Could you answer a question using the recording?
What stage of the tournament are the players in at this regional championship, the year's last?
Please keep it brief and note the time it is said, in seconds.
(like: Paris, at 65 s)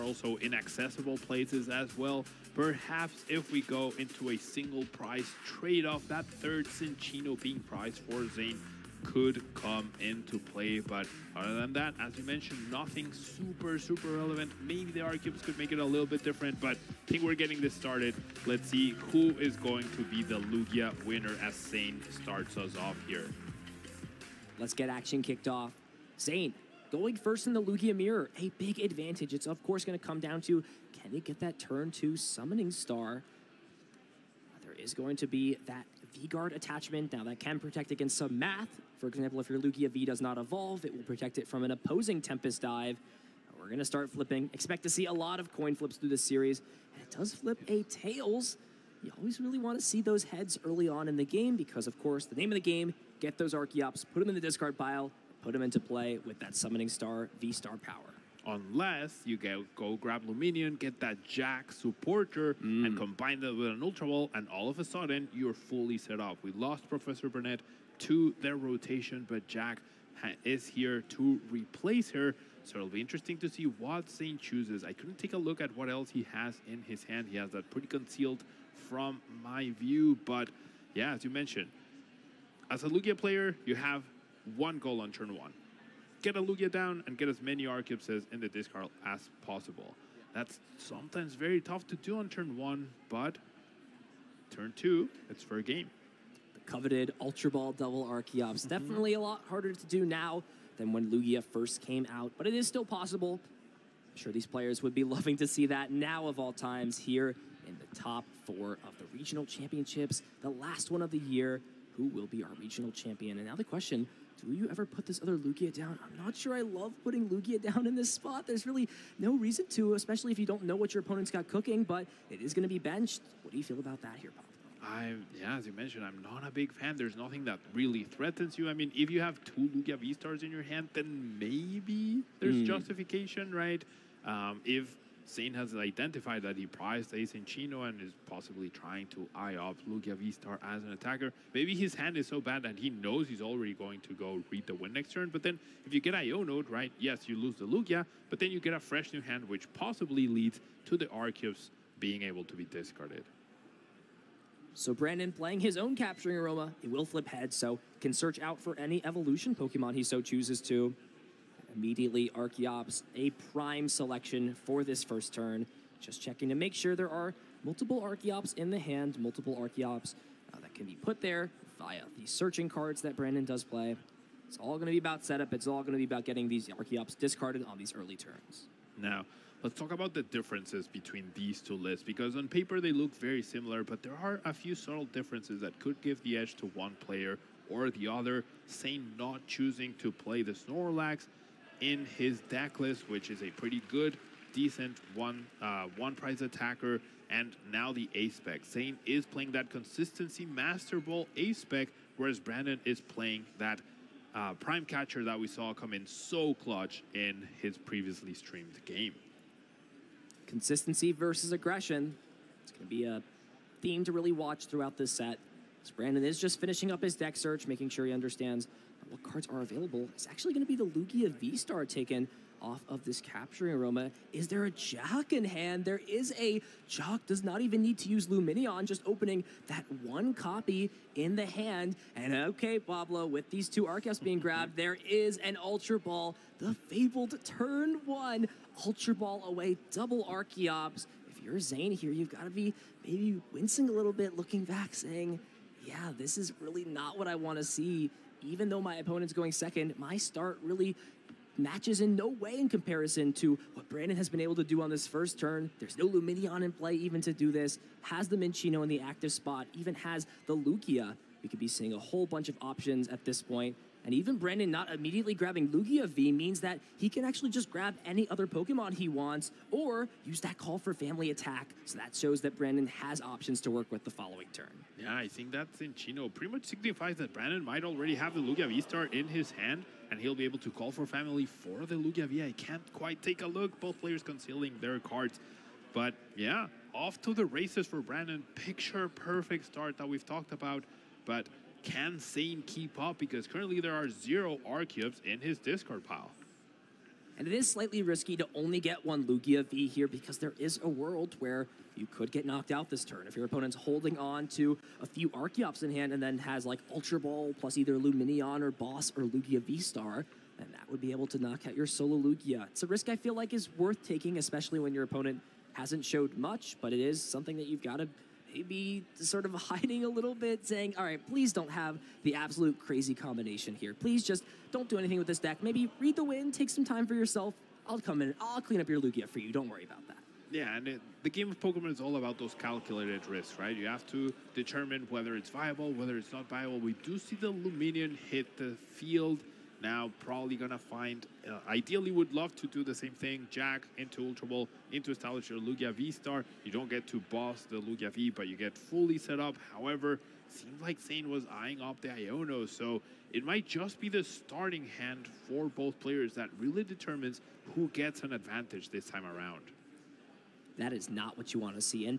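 Top four, at 108 s.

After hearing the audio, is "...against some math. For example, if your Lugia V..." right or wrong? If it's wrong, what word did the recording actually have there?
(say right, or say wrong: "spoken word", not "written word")
right.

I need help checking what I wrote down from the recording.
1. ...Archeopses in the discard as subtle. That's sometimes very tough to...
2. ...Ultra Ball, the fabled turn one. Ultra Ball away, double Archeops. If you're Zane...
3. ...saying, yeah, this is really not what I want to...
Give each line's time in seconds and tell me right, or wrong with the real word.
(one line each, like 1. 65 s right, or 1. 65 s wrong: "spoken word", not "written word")
1. 87 s wrong: "possible", not "subtle"
2. 235 s right
3. 244 s right.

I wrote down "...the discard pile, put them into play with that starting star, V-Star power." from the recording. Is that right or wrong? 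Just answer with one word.
wrong.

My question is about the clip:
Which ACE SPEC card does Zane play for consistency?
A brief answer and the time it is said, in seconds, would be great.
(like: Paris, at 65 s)
Master Ball, at 200 s.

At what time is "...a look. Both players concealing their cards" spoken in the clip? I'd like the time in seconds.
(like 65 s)
283 s.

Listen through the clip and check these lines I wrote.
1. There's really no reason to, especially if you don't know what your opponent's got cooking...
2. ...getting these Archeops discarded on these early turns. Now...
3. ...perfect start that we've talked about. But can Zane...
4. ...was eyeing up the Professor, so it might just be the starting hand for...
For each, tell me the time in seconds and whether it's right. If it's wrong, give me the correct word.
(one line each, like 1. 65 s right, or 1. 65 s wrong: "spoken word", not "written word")
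1. 118 s right
2. 176 s right
3. 289 s right
4. 351 s wrong: "Iono", not "Professor".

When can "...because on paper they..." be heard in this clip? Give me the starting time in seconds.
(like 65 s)
182 s.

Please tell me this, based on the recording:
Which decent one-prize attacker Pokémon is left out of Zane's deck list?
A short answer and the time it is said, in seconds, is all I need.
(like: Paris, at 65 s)
Snorlax, at 190 s.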